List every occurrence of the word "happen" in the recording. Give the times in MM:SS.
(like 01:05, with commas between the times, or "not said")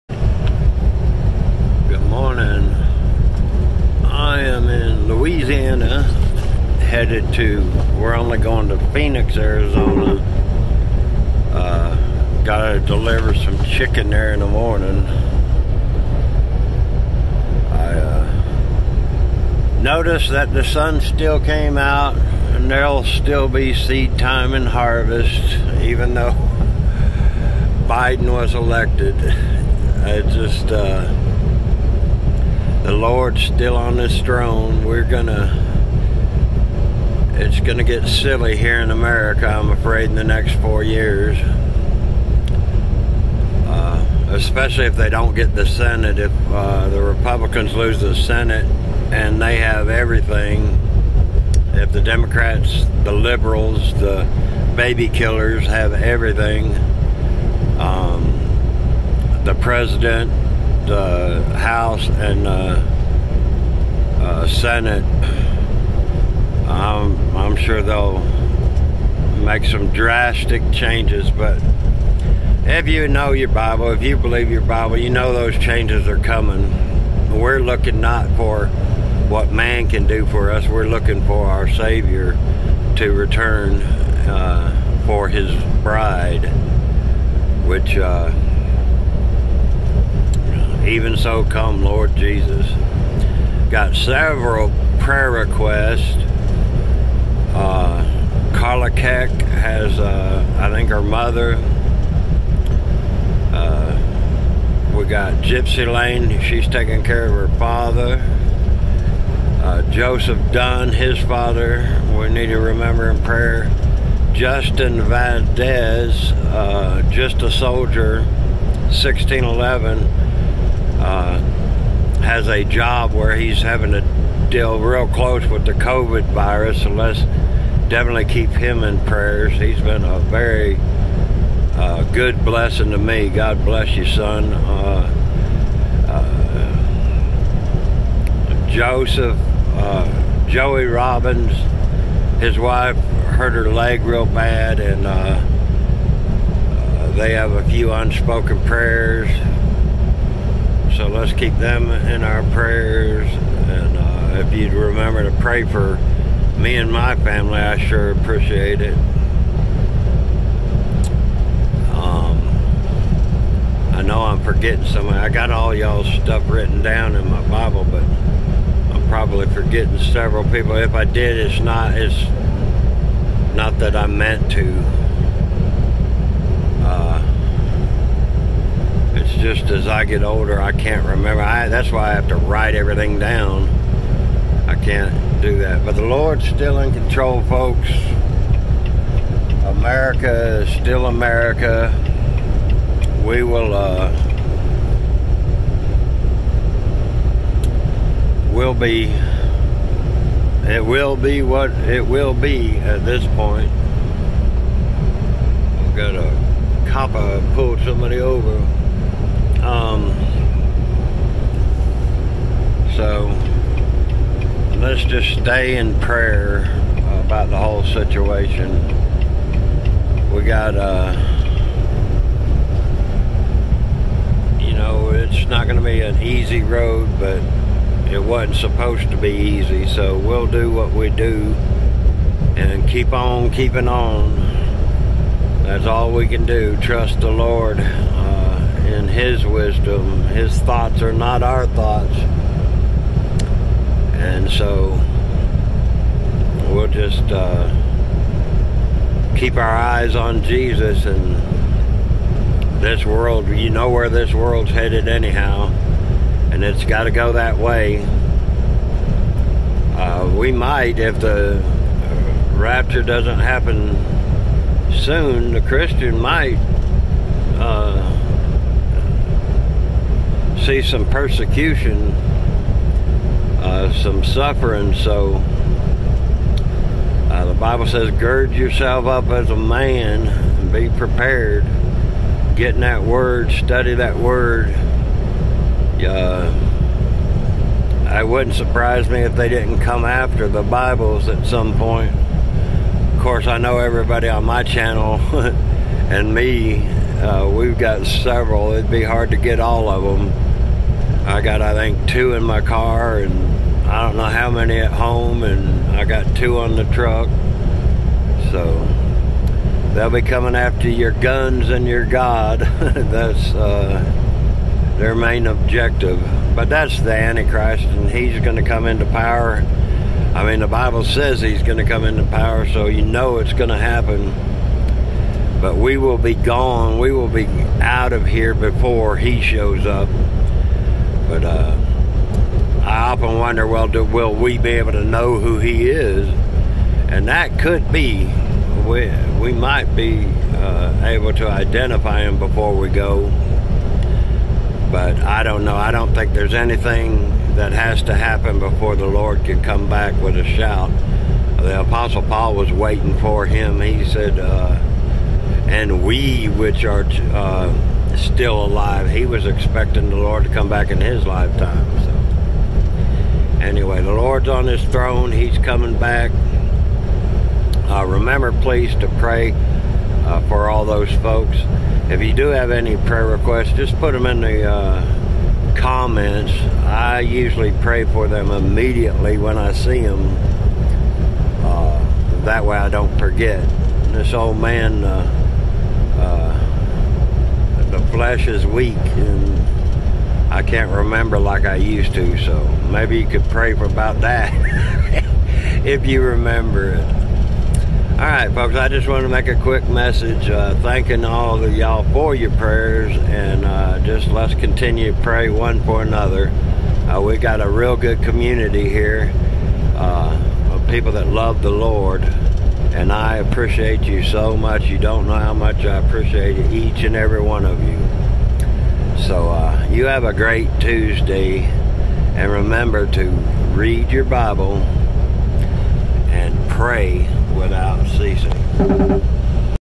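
04:23, 05:23, 05:48.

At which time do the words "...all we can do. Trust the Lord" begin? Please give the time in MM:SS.
03:55.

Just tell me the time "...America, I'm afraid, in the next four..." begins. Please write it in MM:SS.
00:38.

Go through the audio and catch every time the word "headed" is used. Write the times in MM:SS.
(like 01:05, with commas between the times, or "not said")
00:06, 04:14.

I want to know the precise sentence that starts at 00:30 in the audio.
I just, uh, the Lord's still on this throne.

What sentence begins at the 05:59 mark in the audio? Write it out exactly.
He was expecting the Lord to come back in his lifetime.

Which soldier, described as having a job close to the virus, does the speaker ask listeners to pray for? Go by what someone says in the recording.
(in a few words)
Justin Valdez.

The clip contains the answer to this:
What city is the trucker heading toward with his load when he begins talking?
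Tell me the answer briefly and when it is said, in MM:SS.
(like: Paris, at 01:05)
Phoenix, at 00:08.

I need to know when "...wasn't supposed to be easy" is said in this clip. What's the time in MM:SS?
03:48.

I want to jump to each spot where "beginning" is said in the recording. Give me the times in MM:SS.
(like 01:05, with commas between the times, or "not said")
not said.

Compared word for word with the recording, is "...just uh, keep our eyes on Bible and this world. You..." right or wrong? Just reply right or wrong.
wrong.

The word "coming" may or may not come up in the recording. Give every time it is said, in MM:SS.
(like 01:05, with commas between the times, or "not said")
01:16, 05:10, 06:05.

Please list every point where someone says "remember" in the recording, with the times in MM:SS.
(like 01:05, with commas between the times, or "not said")
01:52, 02:34, 03:01, 06:08, 06:30, 06:36, 07:02.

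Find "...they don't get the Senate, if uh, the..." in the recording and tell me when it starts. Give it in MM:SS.
00:44.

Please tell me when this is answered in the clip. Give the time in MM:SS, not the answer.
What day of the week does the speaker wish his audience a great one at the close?
07:00.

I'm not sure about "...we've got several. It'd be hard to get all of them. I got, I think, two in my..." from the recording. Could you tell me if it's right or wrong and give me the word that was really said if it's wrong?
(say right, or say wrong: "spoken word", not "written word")
right.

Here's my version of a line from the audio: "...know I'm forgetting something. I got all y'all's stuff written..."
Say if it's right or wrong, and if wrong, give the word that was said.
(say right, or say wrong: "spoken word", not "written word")
right.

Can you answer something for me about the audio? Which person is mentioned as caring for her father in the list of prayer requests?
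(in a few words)
Gypsy Lane.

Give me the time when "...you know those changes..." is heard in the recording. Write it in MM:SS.
01:14.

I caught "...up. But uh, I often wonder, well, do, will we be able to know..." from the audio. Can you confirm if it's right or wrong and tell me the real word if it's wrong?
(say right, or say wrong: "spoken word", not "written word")
right.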